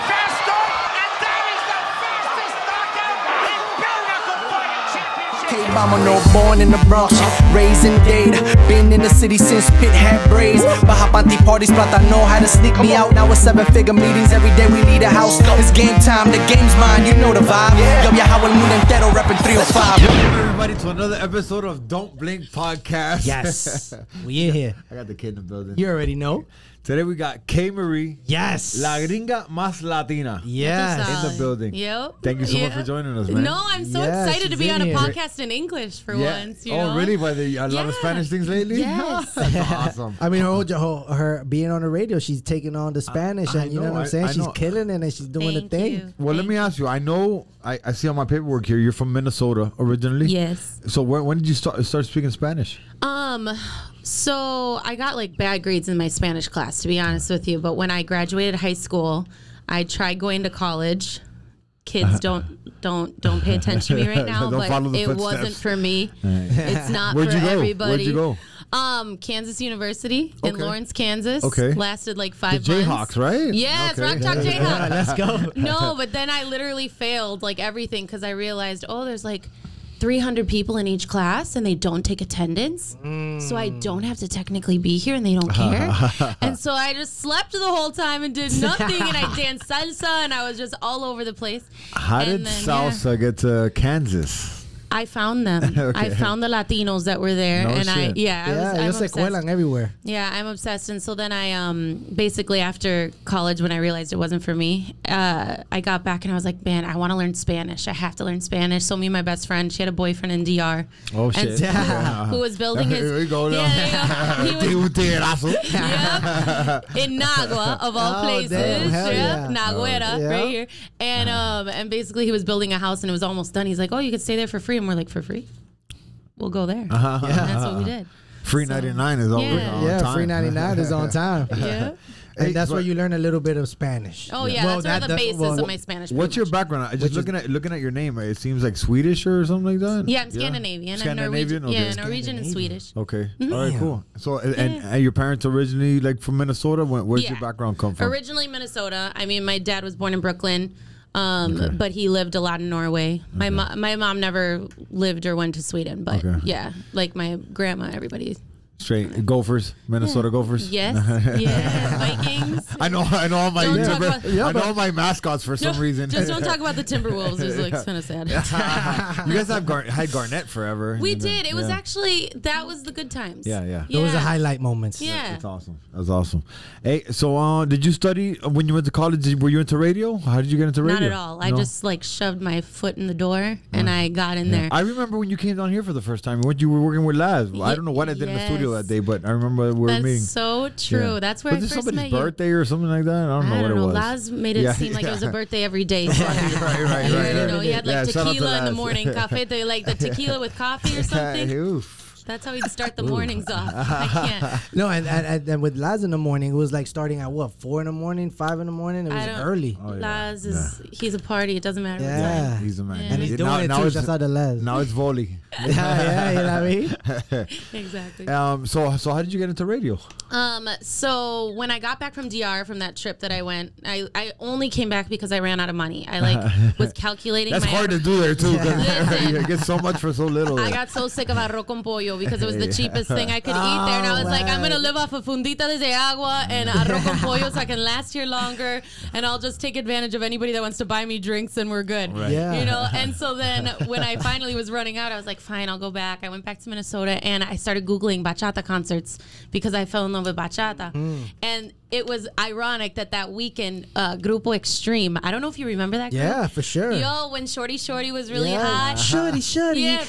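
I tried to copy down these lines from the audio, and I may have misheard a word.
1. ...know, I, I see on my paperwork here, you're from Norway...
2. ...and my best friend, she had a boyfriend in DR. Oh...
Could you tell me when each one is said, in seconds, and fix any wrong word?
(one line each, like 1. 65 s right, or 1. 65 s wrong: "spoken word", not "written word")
1. 46 s wrong: "Minnesota", not "Norway"
2. 109 s right.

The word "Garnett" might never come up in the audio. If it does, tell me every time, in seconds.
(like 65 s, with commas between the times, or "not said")
170 s.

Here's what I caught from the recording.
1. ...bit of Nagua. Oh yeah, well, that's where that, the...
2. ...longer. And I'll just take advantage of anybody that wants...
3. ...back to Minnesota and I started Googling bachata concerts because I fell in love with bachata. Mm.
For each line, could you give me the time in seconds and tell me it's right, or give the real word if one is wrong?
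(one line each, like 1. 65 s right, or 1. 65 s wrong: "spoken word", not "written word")
1. 133 s wrong: "Spanish", not "Nagua"
2. 238 s right
3. 246 s right.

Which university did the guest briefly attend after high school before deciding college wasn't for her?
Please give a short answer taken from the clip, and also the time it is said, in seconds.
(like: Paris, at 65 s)
Kansas University, at 69 s.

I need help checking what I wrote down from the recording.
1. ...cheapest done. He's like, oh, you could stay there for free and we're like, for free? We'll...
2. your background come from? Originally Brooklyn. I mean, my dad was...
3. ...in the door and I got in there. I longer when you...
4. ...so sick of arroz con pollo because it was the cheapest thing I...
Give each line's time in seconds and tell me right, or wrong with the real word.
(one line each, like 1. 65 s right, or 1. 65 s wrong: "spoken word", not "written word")
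1. 123 s wrong: "almost", not "cheapest"
2. 147 s wrong: "Minnesota", not "Brooklyn"
3. 182 s wrong: "remember", not "longer"
4. 230 s right.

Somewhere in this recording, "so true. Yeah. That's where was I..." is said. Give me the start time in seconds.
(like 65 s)
190 s.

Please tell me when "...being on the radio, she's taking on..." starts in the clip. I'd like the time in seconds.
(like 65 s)
41 s.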